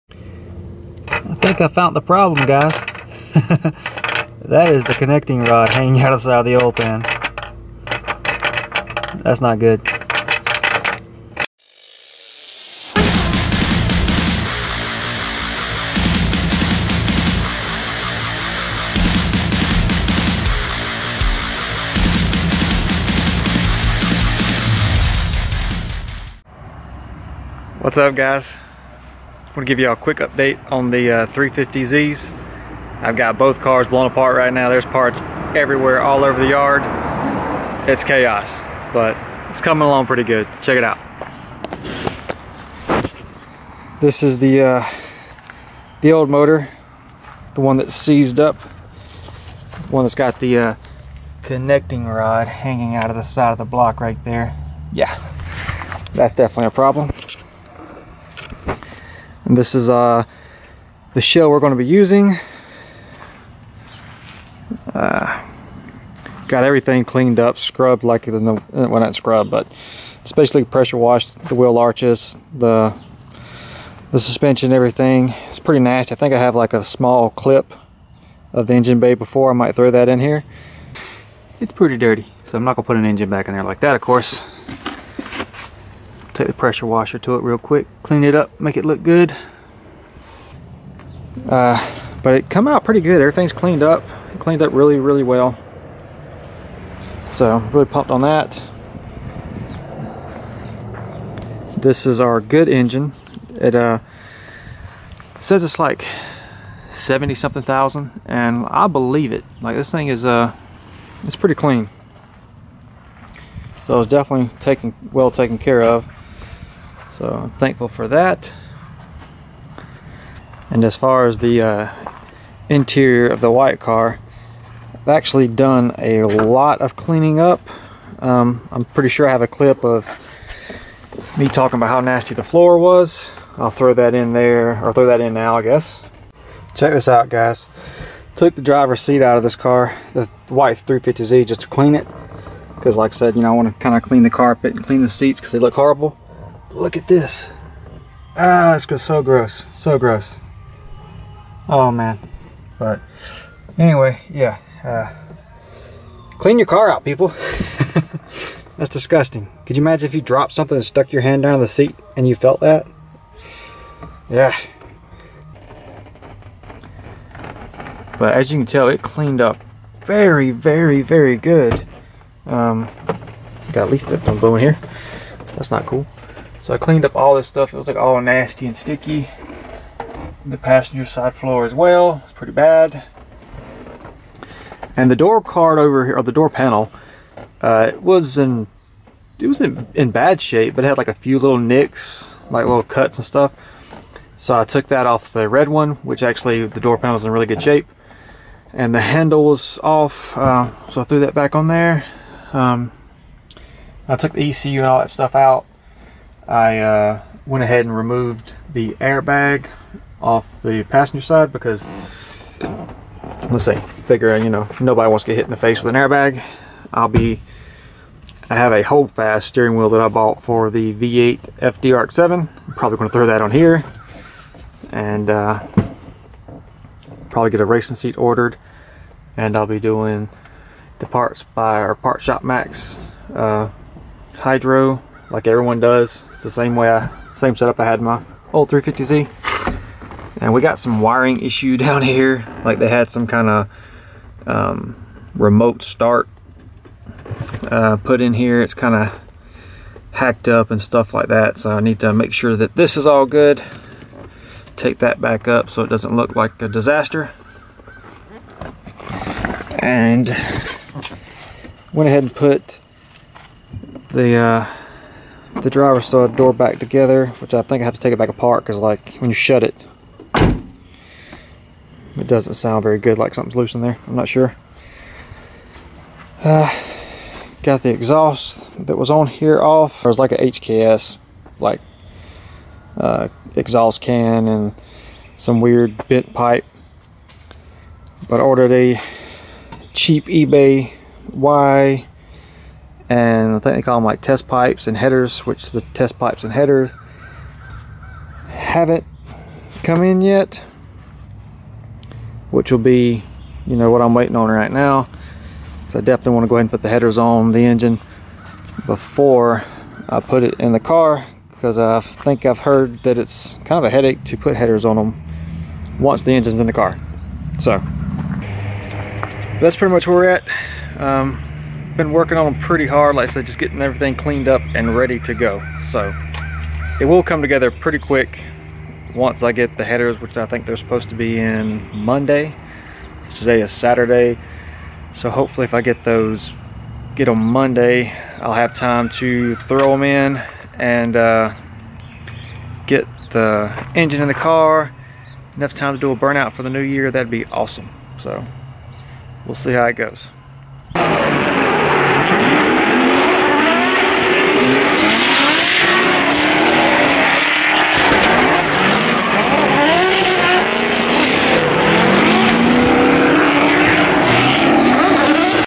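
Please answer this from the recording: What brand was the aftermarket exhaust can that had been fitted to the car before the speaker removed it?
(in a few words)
HKS.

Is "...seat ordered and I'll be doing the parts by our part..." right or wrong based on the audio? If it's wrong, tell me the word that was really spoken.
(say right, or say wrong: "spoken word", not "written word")
right.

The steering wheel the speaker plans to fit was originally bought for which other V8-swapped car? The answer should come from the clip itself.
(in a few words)
FD RX-7.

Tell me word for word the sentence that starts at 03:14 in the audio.
So I took that off the red one, which actually the door panel was in really good shape.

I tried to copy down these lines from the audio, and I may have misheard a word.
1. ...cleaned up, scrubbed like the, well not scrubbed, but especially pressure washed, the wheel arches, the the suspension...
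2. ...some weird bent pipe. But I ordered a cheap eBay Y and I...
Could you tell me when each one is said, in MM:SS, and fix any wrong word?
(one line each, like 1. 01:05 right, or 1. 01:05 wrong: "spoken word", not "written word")
1. 01:07 right
2. 04:45 right.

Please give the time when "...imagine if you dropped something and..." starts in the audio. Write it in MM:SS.
02:39.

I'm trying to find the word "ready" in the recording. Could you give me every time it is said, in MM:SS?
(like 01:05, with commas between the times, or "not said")
05:24.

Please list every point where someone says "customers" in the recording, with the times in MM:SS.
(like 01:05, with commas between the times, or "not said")
not said.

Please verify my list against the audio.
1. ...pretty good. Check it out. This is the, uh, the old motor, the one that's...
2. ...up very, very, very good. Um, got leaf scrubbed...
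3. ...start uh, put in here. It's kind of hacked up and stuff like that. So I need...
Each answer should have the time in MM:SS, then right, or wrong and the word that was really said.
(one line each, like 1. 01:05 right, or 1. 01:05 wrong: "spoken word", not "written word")
1. 00:40 right
2. 02:49 wrong: "tipped", not "scrubbed"
3. 04:05 right.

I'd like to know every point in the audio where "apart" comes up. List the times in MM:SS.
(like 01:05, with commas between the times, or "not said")
00:34, 04:28.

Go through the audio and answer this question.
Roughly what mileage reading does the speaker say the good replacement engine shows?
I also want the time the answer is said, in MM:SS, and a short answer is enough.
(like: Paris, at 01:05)
70 something thousand, at 01:46.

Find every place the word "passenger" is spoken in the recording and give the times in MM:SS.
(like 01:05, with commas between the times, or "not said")
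03:00, 03:30.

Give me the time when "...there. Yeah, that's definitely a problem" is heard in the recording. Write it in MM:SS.
00:54.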